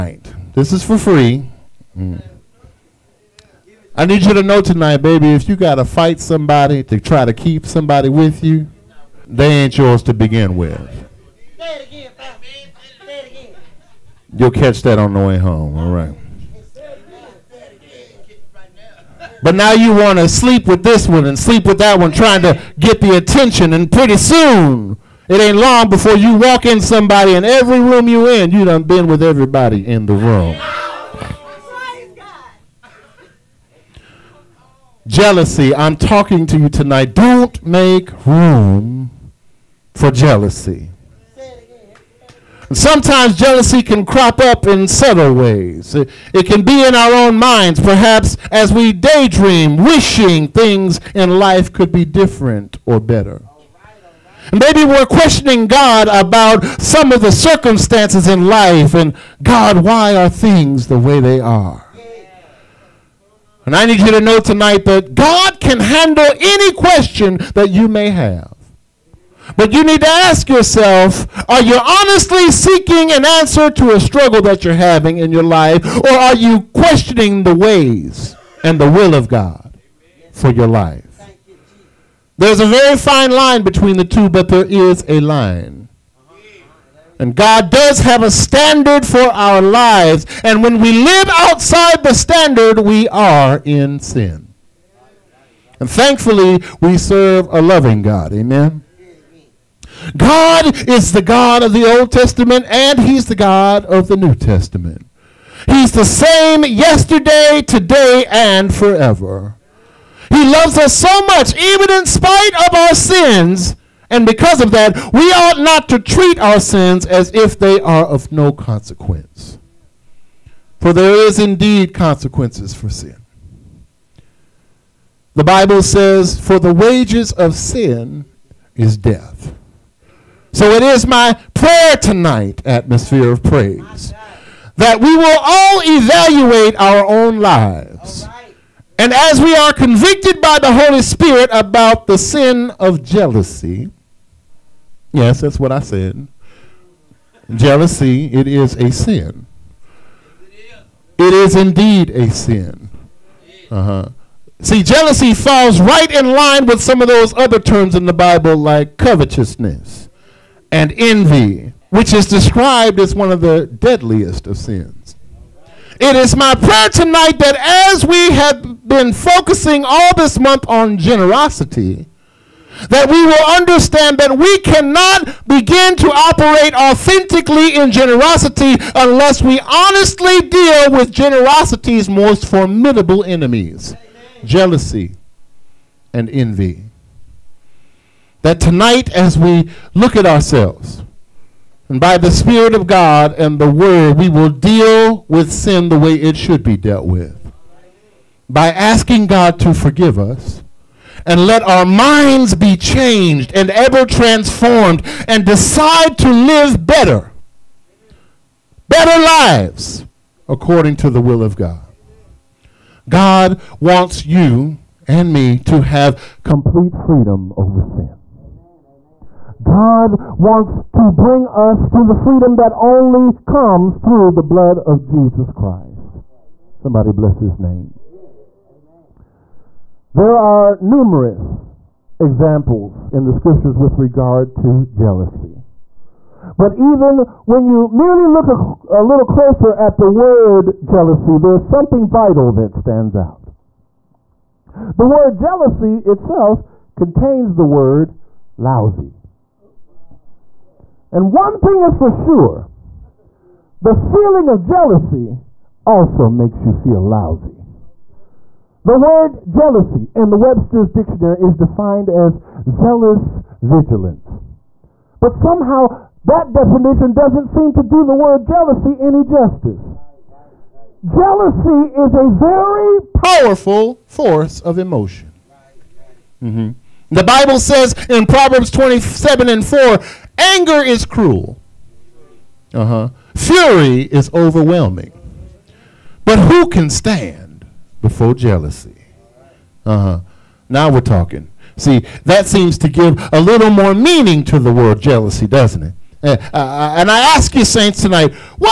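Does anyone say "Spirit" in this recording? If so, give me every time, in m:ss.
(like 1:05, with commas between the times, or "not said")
2:21, 3:12.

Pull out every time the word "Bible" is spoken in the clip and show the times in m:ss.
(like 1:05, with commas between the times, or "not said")
2:05, 2:38, 4:37.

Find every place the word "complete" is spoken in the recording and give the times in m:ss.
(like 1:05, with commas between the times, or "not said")
3:36.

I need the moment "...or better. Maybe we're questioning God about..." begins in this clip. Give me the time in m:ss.
0:52.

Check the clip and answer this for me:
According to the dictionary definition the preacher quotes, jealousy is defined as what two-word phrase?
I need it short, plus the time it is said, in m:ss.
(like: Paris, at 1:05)
zealous vigilance, at 4:22.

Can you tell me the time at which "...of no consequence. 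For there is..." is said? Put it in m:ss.
1:58.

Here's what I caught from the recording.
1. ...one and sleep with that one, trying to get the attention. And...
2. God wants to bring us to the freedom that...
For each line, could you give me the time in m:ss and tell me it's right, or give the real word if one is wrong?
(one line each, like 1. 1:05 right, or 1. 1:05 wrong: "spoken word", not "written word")
1. 0:21 right
2. 3:39 right.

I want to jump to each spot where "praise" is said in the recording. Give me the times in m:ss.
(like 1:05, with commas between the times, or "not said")
2:13.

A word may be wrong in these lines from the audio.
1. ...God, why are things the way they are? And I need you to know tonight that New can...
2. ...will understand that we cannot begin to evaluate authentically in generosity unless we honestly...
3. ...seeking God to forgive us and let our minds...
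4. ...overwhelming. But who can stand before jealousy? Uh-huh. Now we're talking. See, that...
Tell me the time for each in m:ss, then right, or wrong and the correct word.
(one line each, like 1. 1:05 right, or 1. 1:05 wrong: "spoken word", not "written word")
1. 0:59 wrong: "God", not "New"
2. 2:53 wrong: "operate", not "evaluate"
3. 3:18 wrong: "asking", not "seeking"
4. 4:44 right.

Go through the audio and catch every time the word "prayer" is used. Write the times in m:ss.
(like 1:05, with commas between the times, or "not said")
2:11, 2:46.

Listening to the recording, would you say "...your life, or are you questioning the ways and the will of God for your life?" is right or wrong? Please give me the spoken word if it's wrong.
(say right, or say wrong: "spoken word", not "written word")
right.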